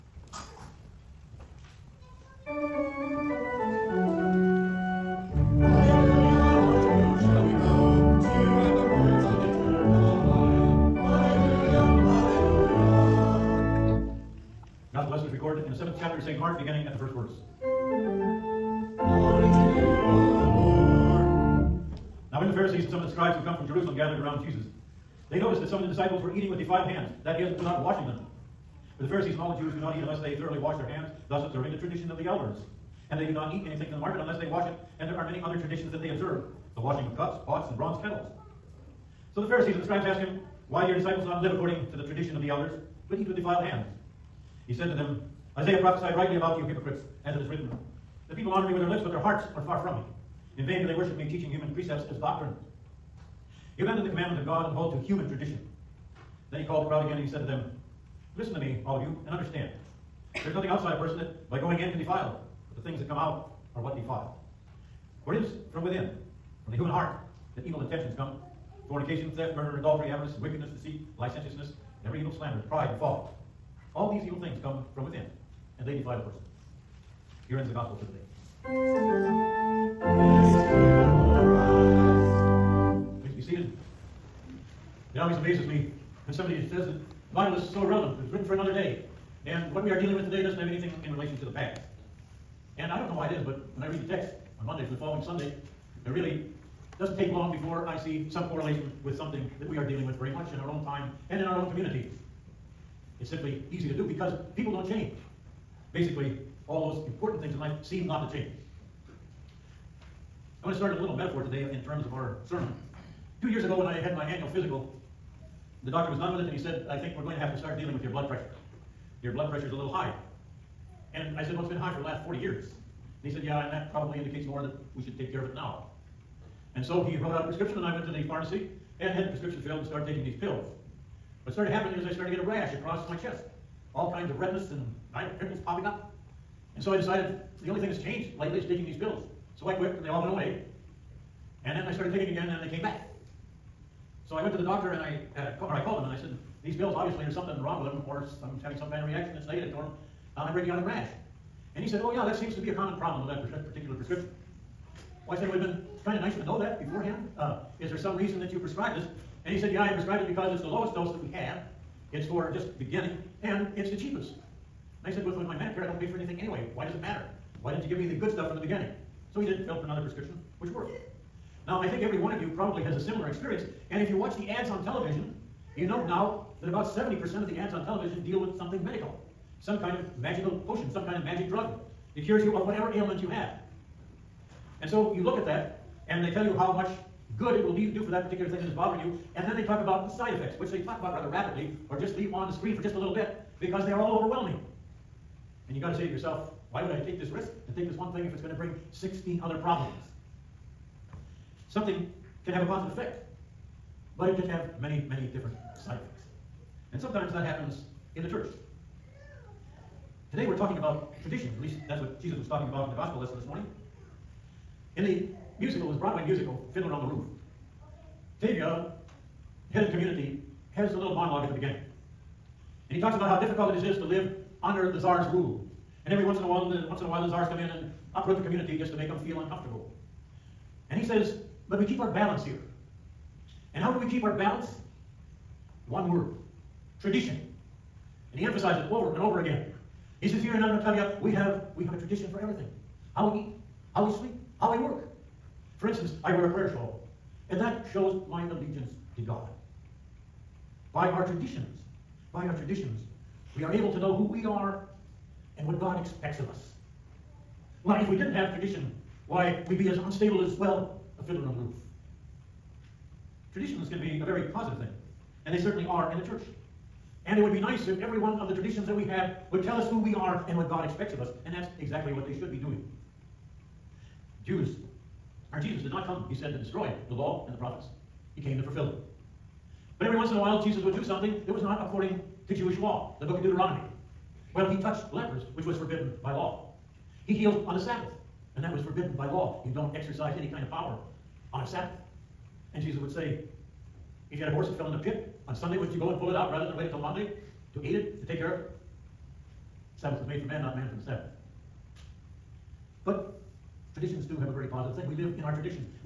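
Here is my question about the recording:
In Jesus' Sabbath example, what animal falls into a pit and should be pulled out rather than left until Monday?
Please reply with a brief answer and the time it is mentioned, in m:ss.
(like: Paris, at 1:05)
horse, at 4:54.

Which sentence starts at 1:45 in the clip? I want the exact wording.
Basically, all those important things in life seem not to change.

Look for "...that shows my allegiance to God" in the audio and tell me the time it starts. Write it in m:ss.
4:07.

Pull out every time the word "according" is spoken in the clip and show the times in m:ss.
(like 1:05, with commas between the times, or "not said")
0:41, 4:41.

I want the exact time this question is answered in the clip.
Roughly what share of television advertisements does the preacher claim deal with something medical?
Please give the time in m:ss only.
2:56.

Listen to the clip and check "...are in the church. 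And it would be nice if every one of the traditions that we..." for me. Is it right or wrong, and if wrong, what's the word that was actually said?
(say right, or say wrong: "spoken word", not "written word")
right.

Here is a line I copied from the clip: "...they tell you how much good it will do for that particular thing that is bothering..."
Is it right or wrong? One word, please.
right.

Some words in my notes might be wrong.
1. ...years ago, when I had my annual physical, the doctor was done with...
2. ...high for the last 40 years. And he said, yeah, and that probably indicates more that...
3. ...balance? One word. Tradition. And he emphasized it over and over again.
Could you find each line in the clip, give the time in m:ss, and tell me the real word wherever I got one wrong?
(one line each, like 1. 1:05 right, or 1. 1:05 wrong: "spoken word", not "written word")
1. 1:53 right
2. 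2:01 right
3. 3:54 right.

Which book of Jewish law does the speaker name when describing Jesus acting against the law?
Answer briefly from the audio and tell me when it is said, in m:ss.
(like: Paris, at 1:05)
Deuteronomy, at 4:43.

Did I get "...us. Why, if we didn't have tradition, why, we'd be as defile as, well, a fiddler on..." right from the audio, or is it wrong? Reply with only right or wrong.
wrong.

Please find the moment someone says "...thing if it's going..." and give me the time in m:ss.
3:18.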